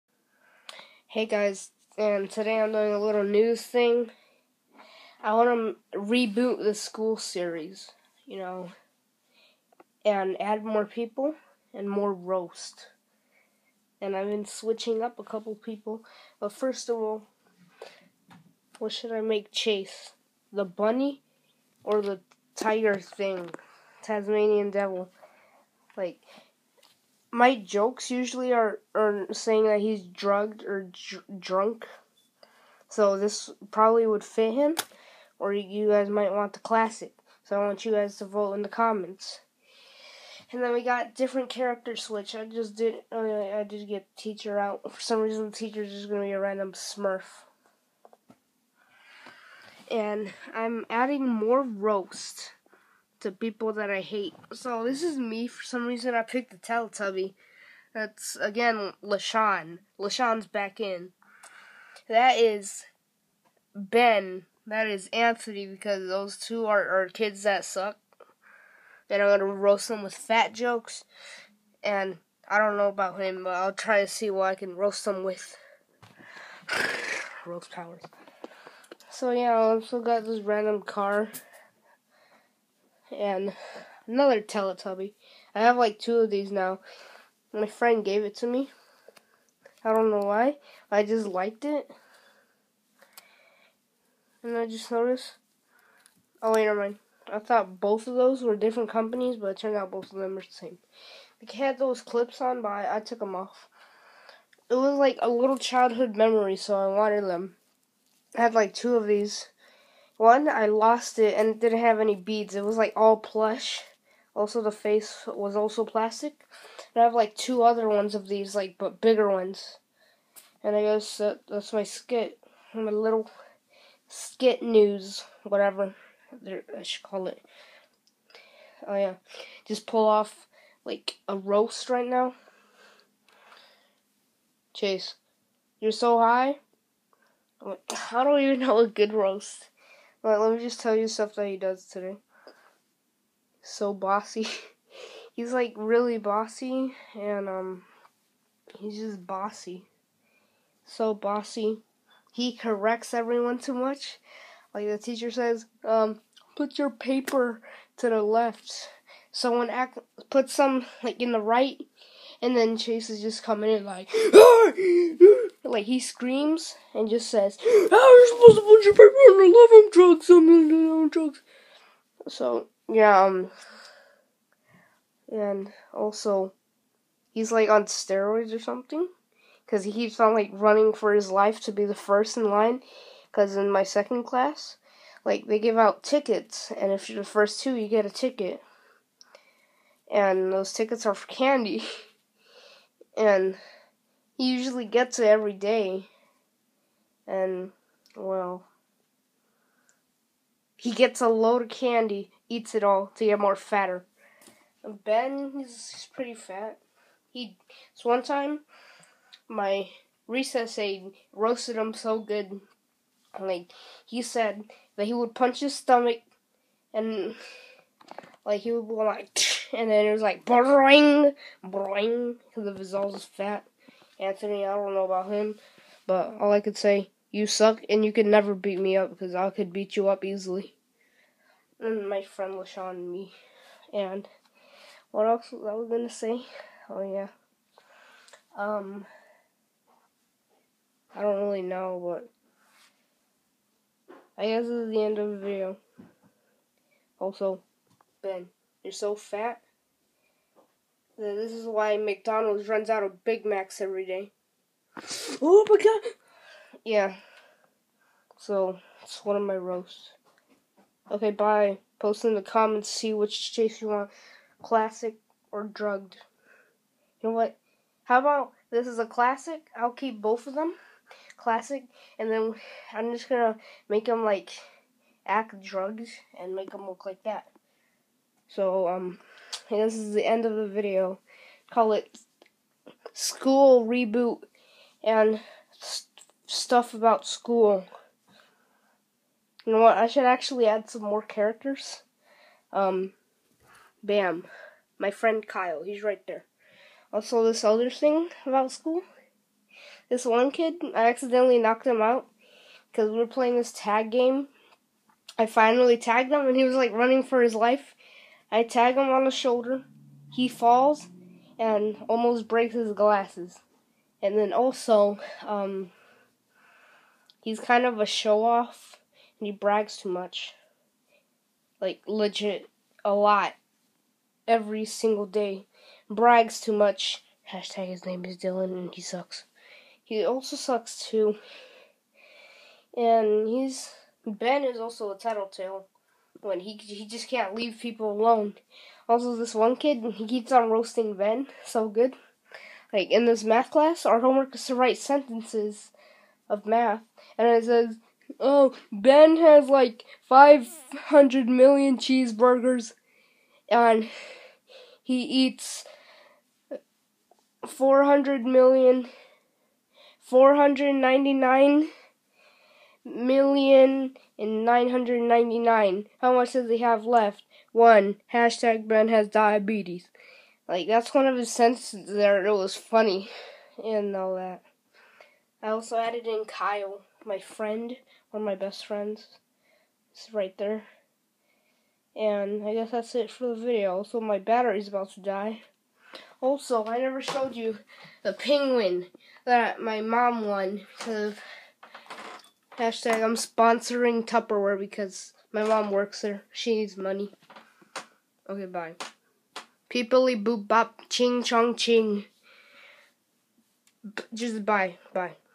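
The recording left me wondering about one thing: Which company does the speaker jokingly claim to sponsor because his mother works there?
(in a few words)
Tupperware.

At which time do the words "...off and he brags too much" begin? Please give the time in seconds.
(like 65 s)
318 s.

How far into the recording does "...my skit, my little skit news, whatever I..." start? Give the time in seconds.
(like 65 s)
121 s.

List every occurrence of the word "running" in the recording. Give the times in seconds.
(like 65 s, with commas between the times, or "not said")
180 s, 306 s.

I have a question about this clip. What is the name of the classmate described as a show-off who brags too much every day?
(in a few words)
Dylan.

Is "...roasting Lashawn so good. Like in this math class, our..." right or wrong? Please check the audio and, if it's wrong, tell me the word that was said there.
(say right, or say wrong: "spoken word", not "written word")
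wrong: "Ben", not "Lashawn".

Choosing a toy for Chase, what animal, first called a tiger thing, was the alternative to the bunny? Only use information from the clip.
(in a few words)
Tasmanian devil.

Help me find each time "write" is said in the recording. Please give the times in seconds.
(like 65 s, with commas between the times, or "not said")
344 s.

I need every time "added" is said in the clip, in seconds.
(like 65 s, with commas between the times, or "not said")
375 s.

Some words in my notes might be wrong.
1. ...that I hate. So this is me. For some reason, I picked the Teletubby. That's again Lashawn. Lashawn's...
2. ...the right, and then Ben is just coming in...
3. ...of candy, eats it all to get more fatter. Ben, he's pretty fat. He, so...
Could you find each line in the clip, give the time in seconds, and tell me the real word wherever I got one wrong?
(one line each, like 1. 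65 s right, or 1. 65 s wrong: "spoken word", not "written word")
1. 53 s right
2. 161 s wrong: "Chase", not "Ben"
3. 201 s right.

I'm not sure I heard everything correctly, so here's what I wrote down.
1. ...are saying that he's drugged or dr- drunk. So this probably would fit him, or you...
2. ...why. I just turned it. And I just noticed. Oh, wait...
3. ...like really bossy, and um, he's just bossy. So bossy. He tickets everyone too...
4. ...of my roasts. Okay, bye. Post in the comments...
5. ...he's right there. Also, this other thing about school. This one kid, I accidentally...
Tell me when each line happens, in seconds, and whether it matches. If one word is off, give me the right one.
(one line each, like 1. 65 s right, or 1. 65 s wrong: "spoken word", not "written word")
1. 28 s right
2. 90 s wrong: "liked", not "turned"
3. 145 s wrong: "corrects", not "tickets"
4. 259 s right
5. 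295 s right.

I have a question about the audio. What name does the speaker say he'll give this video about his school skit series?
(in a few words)
School Reboot.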